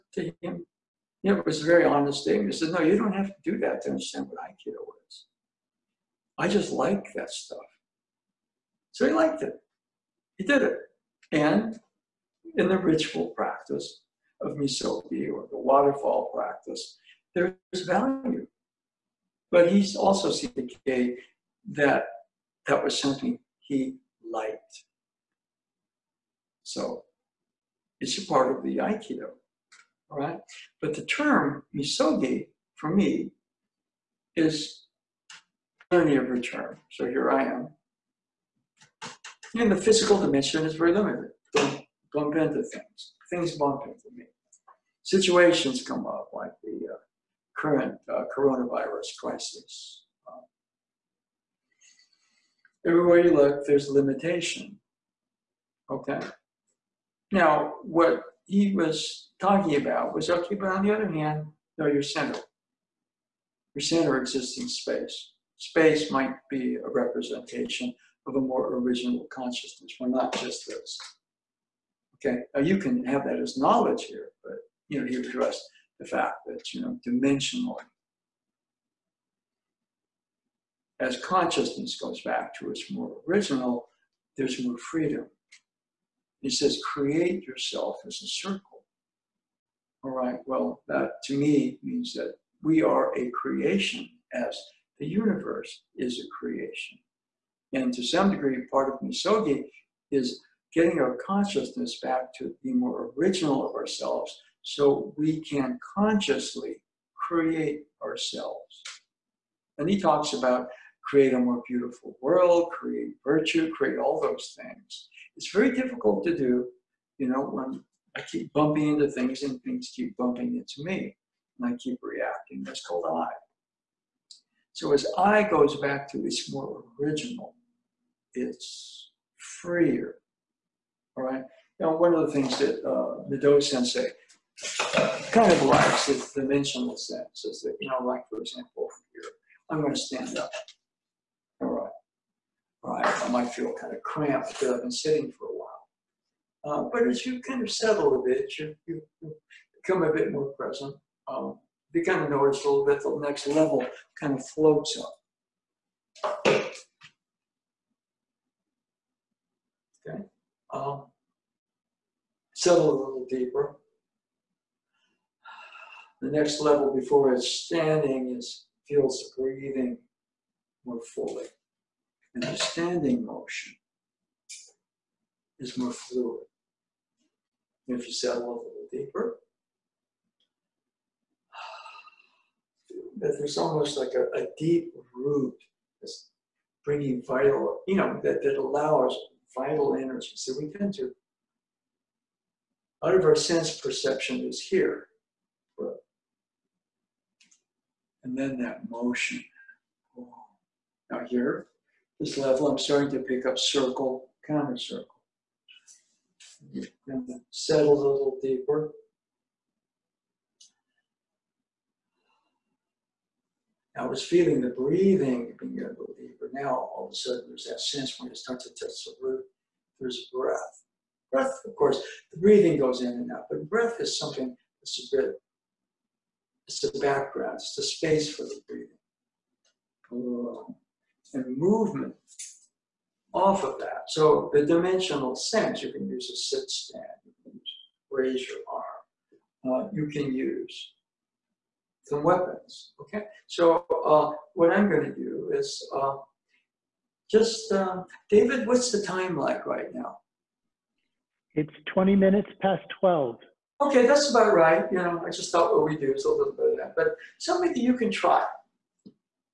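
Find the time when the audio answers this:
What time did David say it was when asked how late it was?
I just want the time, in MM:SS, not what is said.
04:11.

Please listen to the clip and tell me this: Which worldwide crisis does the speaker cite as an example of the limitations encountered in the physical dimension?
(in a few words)
Coronavirus.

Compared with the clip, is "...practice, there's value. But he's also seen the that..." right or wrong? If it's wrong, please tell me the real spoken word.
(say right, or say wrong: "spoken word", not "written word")
right.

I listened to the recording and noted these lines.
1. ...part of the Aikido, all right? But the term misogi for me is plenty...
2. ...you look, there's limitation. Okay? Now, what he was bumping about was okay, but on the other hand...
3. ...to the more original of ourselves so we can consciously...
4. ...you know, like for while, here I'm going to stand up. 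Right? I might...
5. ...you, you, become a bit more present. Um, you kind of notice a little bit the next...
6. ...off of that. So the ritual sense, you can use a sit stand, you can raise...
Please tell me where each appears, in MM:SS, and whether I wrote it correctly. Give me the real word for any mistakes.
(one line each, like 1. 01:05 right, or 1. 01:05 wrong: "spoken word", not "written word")
1. 00:28 right
2. 00:53 wrong: "talking", not "bumping"
3. 01:42 right
4. 02:17 wrong: "example", not "while"
5. 02:28 right
6. 03:53 wrong: "dimensional", not "ritual".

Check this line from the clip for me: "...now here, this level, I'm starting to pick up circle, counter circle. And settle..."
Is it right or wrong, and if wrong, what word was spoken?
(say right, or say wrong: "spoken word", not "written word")
right.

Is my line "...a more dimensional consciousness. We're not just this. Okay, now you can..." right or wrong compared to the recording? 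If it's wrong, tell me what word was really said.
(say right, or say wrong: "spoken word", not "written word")
wrong: "original", not "dimensional".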